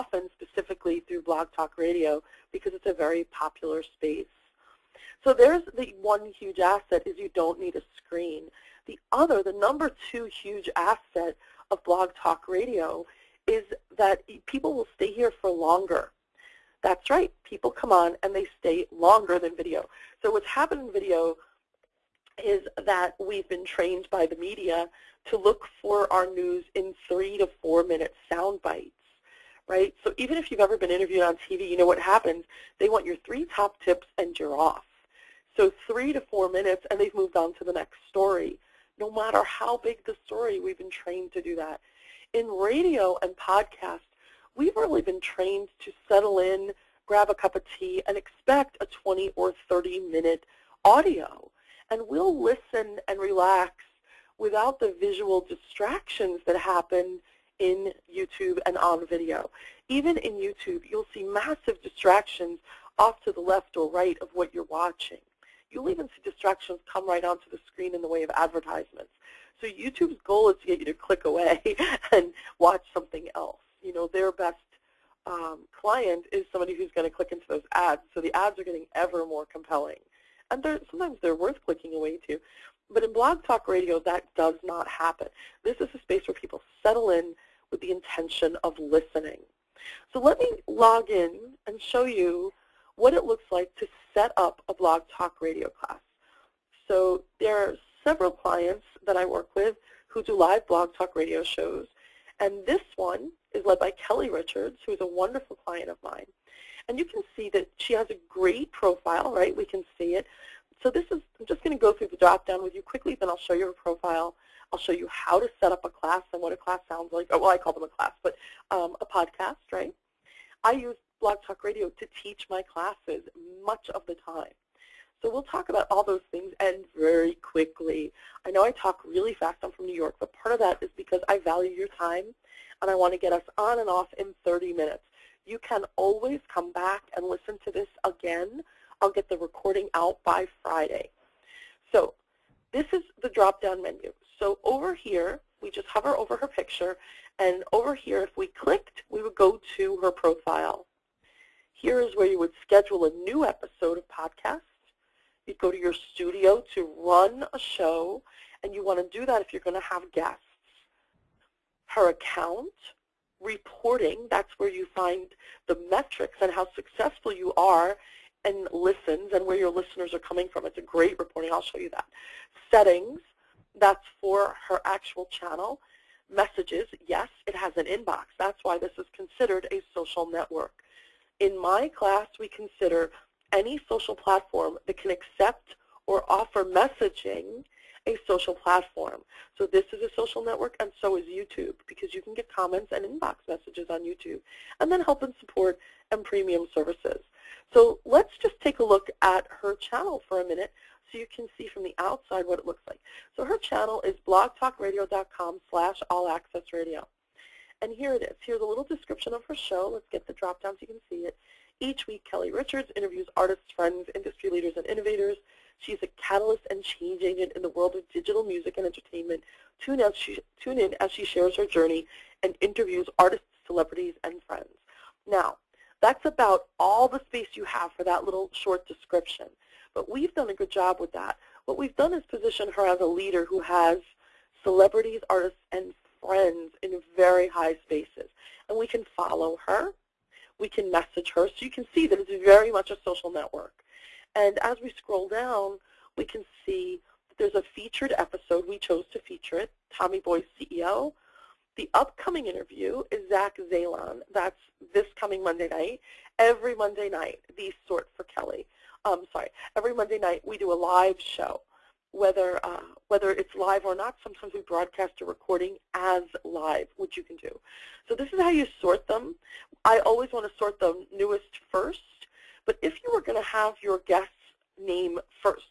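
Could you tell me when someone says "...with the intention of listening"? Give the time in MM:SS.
01:27.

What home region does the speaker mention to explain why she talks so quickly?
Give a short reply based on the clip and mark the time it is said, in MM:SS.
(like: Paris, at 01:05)
New York, at 02:09.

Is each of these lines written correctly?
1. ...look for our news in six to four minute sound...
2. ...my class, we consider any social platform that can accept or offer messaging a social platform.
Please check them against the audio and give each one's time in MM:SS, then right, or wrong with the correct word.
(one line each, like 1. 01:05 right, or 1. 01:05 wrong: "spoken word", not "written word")
1. 00:25 wrong: "three", not "six"
2. 03:01 right.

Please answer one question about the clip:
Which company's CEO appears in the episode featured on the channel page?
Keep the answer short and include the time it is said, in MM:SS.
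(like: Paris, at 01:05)
Tommy Boy, at 04:09.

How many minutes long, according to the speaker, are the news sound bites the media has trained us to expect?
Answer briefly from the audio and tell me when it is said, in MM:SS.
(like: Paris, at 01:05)
3 to 4 minutes, at 00:35.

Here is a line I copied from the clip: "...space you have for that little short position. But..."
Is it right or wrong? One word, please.
wrong.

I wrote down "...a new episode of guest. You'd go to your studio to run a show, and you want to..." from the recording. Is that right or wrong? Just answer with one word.
wrong.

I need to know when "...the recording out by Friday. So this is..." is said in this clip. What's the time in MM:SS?
02:19.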